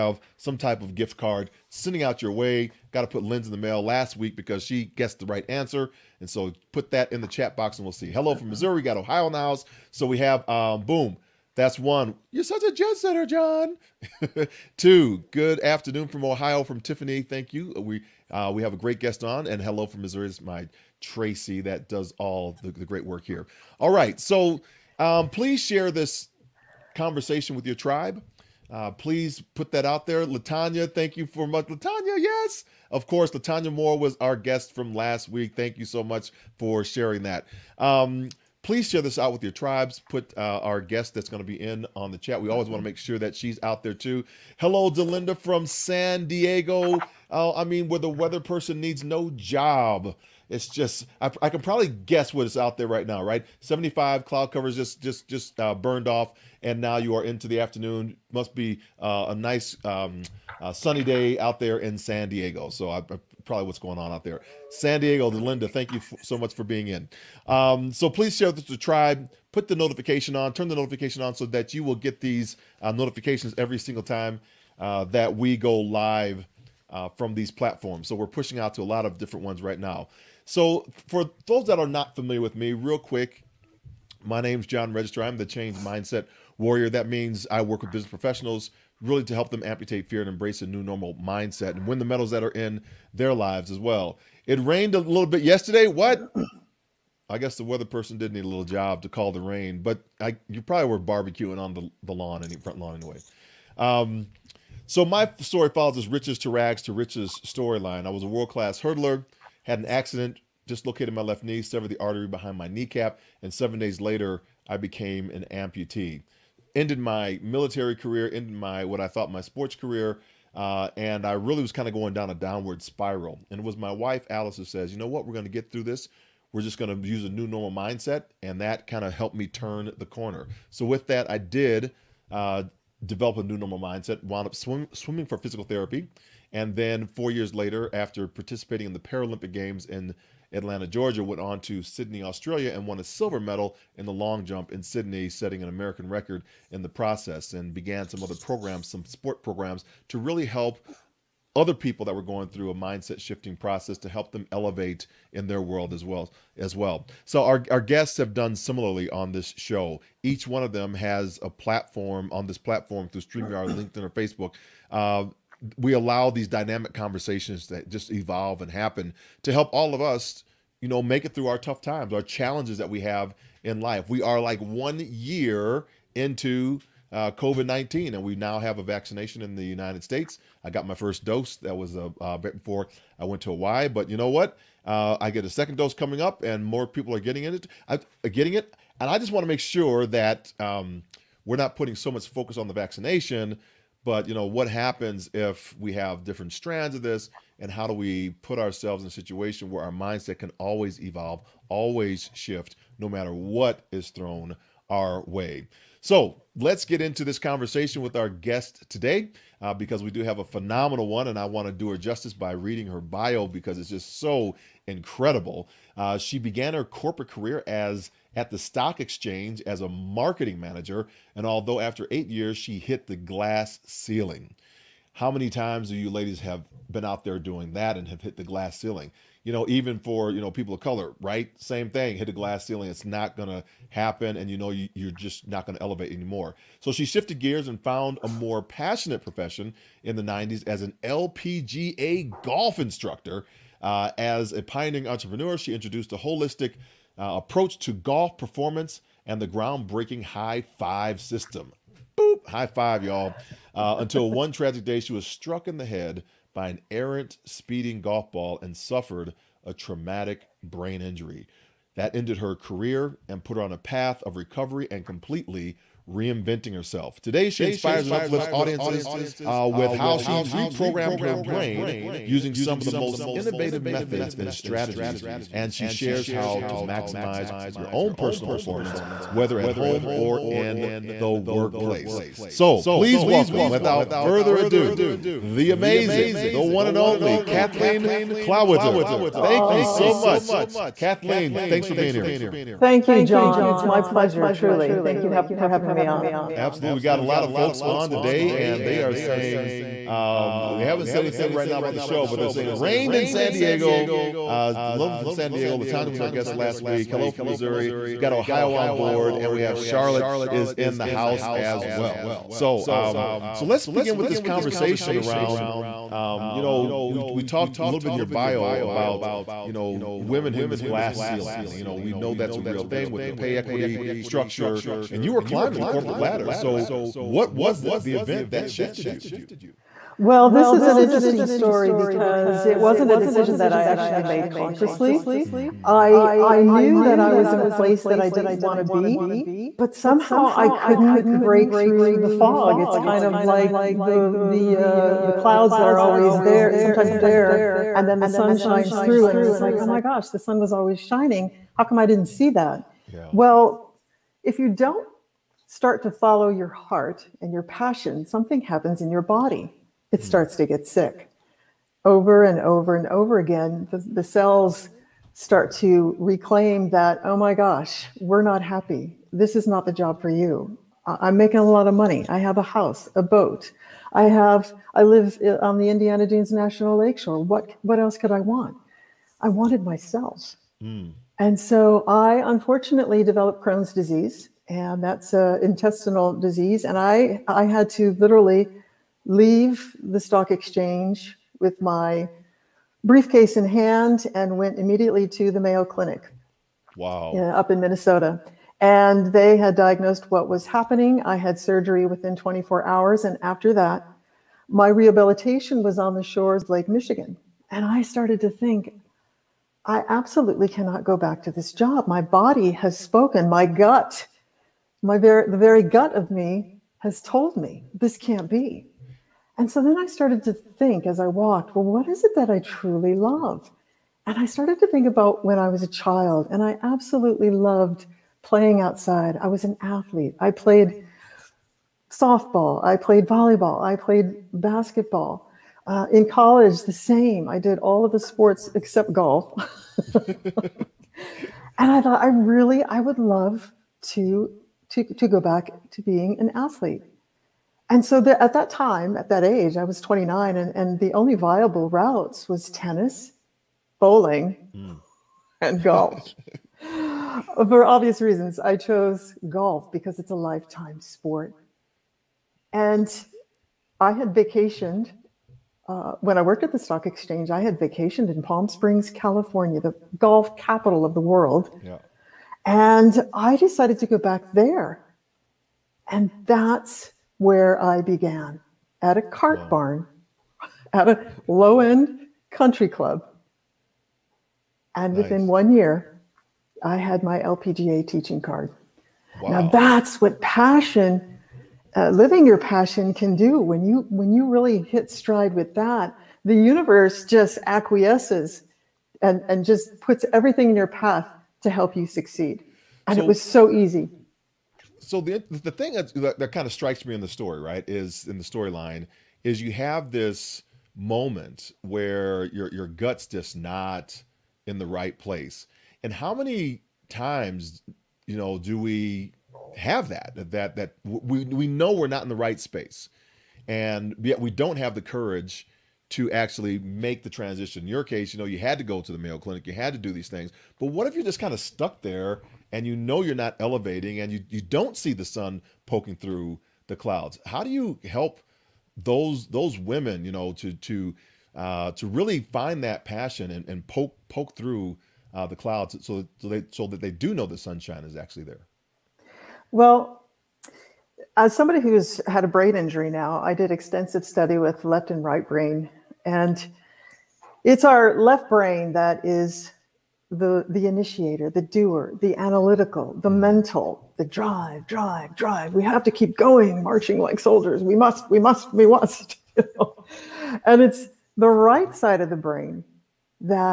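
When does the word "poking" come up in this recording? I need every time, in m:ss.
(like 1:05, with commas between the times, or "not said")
8:55.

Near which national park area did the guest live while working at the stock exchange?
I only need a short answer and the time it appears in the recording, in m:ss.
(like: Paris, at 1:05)
Indiana Dunes National Lakeshore, at 6:15.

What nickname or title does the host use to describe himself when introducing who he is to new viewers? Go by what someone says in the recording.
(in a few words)
Change Mindset Warrior.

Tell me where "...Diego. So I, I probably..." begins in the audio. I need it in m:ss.
1:02.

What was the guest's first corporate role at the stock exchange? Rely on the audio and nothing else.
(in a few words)
Marketing manager.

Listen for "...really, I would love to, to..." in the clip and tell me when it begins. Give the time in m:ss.
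7:22.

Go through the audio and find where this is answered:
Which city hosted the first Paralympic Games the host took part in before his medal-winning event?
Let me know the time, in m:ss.
2:20.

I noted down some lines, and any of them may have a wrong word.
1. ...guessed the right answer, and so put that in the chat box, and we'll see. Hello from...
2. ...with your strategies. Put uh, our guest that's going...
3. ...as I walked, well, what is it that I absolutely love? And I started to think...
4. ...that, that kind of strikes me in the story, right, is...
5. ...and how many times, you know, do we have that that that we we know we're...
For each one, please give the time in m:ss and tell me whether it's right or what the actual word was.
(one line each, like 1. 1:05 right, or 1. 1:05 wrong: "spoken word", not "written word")
1. 0:04 right
2. 0:39 wrong: "tribes", not "strategies"
3. 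7:01 wrong: "truly", not "absolutely"
4. 8:26 right
5. 8:36 right.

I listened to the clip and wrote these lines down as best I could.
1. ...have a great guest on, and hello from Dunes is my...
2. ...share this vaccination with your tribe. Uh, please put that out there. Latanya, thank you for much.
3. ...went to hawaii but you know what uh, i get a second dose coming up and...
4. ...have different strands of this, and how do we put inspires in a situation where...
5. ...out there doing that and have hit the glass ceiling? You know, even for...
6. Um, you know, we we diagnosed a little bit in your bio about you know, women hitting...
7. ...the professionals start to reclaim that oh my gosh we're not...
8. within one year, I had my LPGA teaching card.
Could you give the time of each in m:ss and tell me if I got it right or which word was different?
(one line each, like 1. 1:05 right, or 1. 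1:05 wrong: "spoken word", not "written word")
1. 0:18 wrong: "Missouri", not "Dunes"
2. 0:25 wrong: "conversation", not "vaccination"
3. 3:03 right
4. 3:15 wrong: "ourselves", not "inspires"
5. 3:47 right
6. 5:16 wrong: "talked", not "diagnosed"
7. 6:03 wrong: "cells", not "professionals"
8. 8:05 right.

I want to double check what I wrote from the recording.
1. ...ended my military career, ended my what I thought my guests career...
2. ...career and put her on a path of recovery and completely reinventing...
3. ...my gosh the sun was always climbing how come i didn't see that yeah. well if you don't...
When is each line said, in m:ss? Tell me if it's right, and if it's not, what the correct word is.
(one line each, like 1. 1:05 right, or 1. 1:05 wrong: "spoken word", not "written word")
1. 1:56 wrong: "sports", not "guests"
2. 4:22 right
3. 5:49 wrong: "shining", not "climbing".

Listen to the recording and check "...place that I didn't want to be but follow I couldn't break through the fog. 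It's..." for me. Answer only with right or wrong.
wrong.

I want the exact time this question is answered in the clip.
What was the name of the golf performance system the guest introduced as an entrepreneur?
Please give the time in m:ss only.
4:10.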